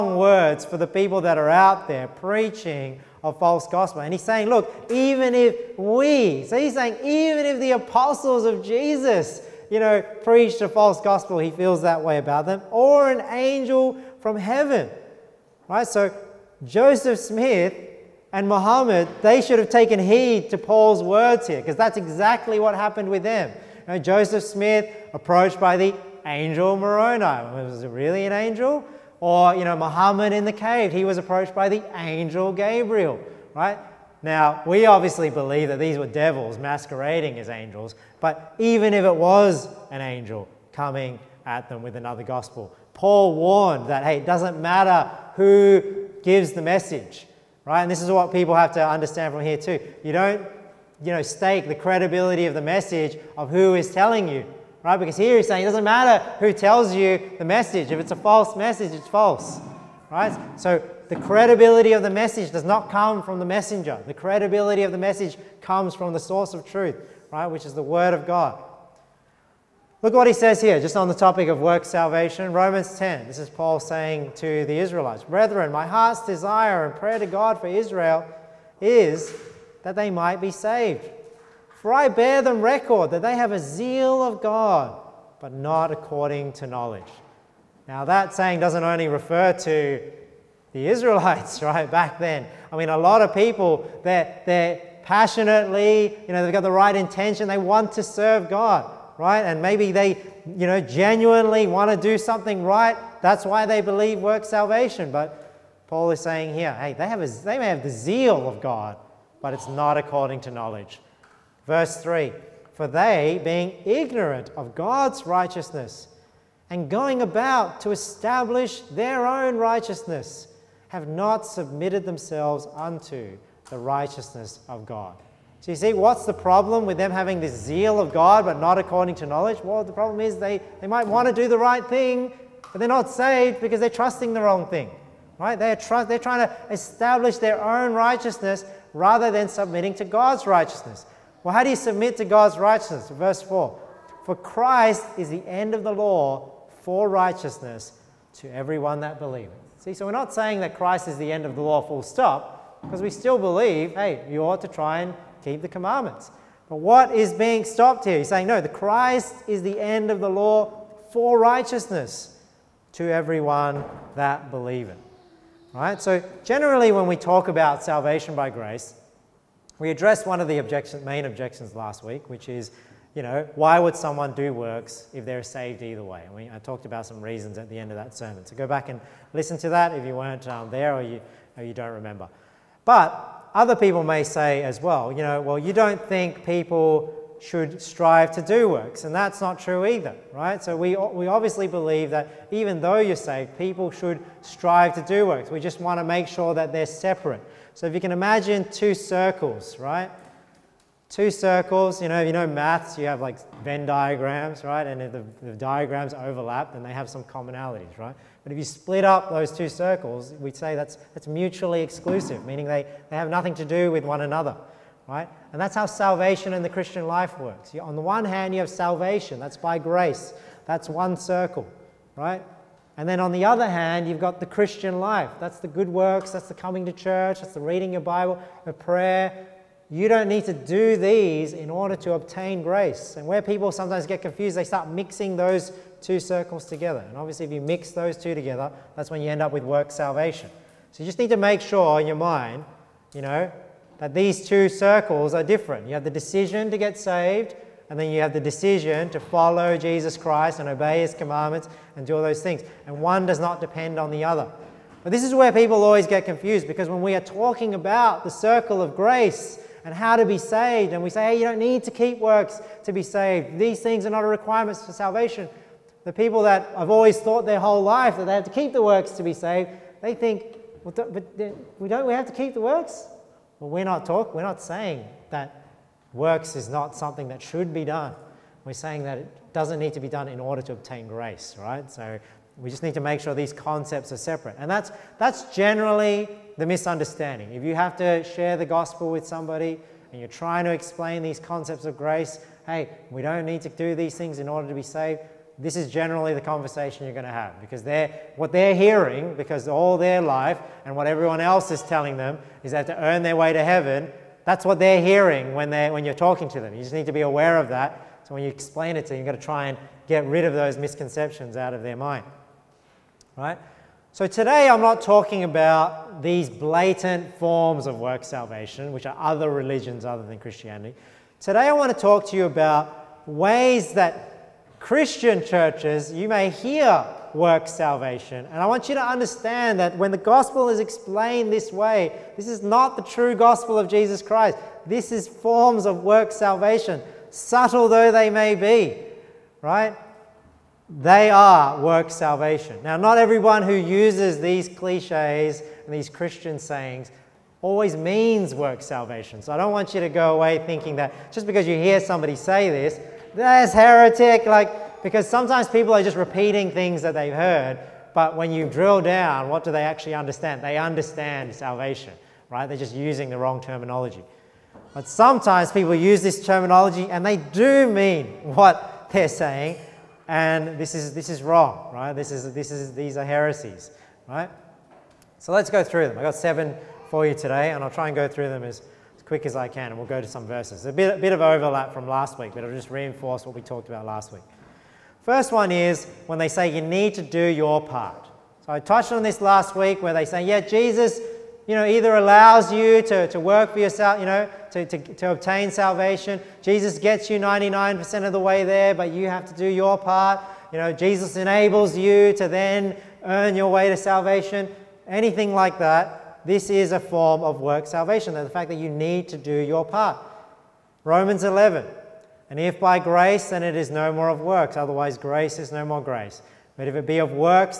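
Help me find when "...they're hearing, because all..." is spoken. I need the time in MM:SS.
04:58.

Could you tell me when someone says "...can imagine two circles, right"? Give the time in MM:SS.
03:17.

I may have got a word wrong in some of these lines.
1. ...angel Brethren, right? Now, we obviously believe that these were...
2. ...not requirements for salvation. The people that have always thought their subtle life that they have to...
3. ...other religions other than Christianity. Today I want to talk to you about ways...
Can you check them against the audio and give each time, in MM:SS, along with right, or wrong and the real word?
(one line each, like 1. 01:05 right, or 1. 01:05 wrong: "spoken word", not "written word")
1. 00:31 wrong: "Gabriel", not "Brethren"
2. 04:24 wrong: "whole", not "subtle"
3. 05:19 right.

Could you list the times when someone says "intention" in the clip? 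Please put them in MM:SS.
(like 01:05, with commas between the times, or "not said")
01:36.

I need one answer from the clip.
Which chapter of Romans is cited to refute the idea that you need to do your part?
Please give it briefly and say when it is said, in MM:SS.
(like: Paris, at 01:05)
Romans 11, at 06:51.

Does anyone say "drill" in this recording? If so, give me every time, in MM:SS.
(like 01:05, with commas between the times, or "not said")
05:58.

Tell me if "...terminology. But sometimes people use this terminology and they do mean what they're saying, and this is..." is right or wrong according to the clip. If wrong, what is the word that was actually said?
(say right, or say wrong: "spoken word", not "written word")
right.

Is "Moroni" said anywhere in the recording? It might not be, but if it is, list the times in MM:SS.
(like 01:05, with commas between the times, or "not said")
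00:26.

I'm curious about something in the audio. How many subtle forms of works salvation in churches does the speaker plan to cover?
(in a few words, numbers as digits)
7.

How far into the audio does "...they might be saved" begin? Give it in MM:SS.
01:19.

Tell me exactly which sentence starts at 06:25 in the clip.
First one is when they say you need to do your part.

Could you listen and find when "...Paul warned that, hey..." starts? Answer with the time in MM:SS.
00:42.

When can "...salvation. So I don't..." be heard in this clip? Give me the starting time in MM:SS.
05:48.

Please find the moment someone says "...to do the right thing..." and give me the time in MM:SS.
02:11.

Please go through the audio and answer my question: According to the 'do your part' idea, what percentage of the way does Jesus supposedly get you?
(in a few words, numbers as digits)
99%.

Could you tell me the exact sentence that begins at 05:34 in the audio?
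This is forms of work salvation, subtle though they may be, right?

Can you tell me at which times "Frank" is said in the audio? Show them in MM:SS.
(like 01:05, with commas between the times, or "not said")
not said.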